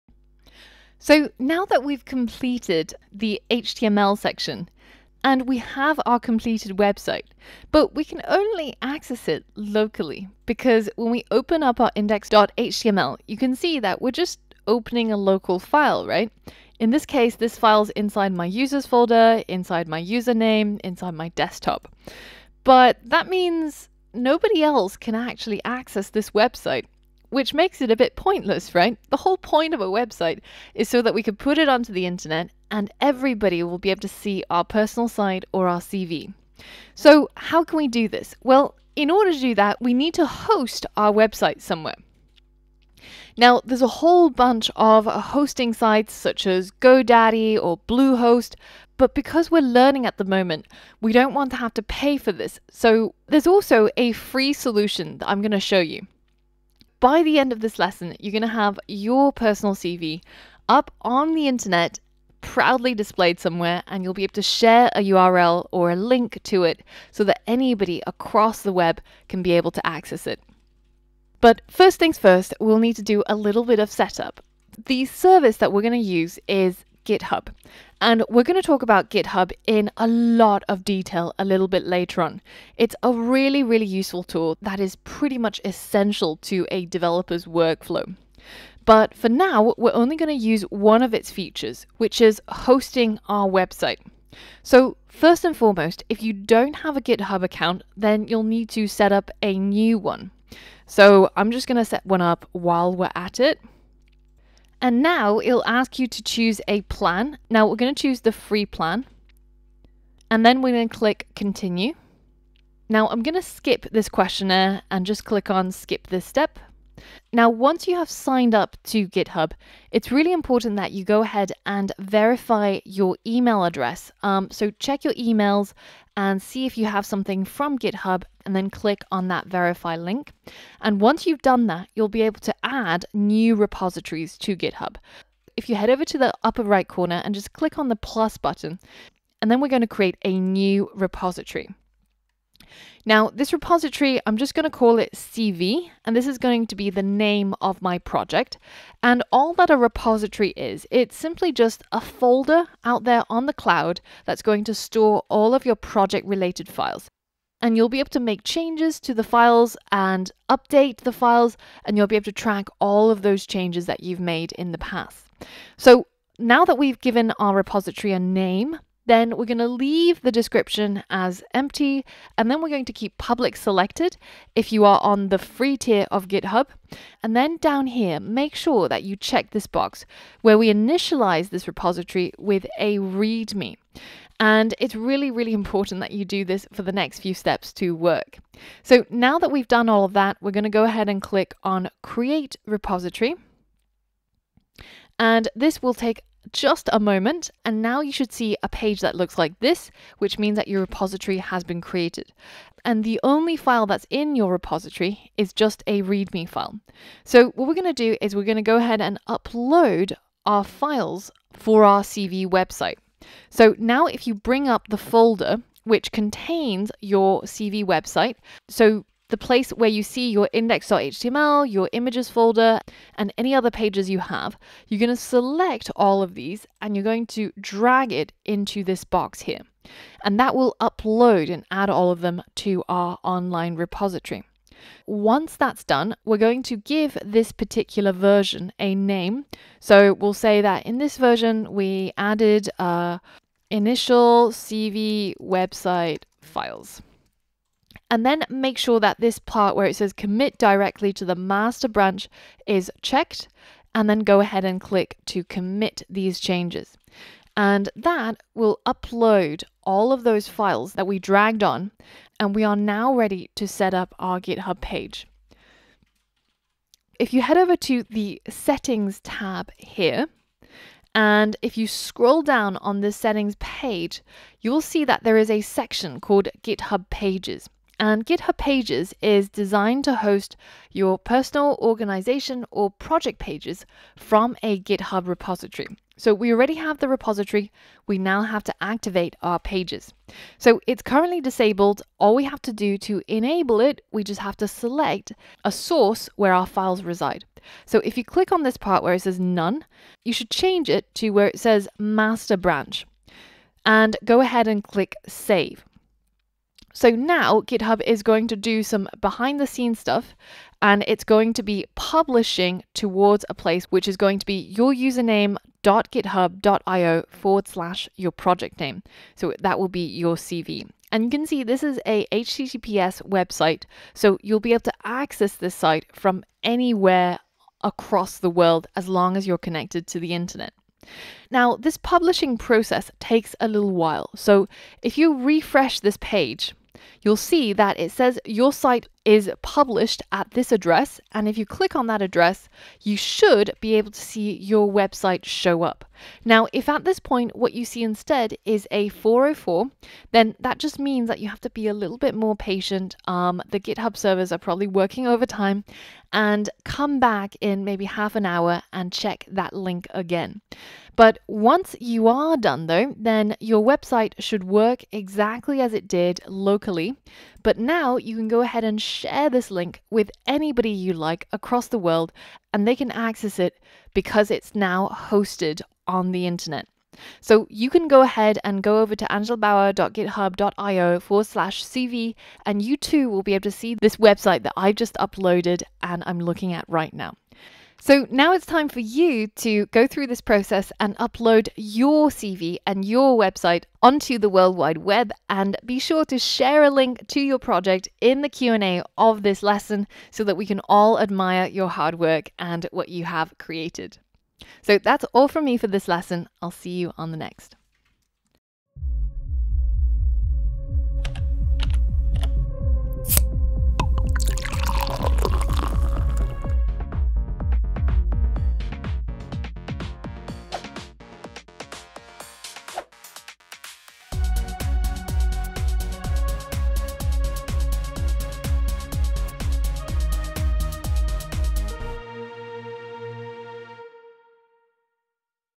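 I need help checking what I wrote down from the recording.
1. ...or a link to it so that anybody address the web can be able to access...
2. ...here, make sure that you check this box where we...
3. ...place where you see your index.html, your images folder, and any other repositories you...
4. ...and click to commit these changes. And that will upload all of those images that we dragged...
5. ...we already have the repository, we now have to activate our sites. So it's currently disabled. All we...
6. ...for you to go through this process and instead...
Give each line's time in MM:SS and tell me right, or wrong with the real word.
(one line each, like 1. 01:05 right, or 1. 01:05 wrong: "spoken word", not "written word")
1. 01:05 wrong: "across", not "address"
2. 02:57 right
3. 03:39 wrong: "pages", not "repositories"
4. 04:14 wrong: "files", not "images"
5. 04:46 wrong: "pages", not "sites"
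6. 06:28 wrong: "upload", not "instead".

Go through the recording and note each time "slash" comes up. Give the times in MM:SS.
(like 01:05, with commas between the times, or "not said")
05:17, 06:21.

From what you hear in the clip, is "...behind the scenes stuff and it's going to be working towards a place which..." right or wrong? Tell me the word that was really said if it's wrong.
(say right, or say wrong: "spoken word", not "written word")
wrong: "publishing", not "working".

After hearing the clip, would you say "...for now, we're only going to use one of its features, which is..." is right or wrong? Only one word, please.
right.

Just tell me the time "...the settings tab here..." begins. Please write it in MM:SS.
04:28.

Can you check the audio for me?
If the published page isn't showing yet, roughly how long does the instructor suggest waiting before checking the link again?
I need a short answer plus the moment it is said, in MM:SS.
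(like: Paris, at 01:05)
half an hour, at 05:58.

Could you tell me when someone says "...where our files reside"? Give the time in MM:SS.
04:56.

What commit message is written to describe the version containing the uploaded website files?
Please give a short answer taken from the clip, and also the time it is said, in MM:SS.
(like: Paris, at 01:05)
initial CV website files, at 04:03.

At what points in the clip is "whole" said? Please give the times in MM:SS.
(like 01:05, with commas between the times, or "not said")
00:29, 00:43.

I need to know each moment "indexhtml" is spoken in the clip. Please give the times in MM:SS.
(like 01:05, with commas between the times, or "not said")
00:11, 03:40.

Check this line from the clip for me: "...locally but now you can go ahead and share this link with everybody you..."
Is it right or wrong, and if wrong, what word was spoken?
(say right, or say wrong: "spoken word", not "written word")
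wrong: "anybody", not "everybody".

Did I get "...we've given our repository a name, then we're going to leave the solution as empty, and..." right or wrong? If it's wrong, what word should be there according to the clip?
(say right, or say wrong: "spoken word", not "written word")
wrong: "description", not "solution".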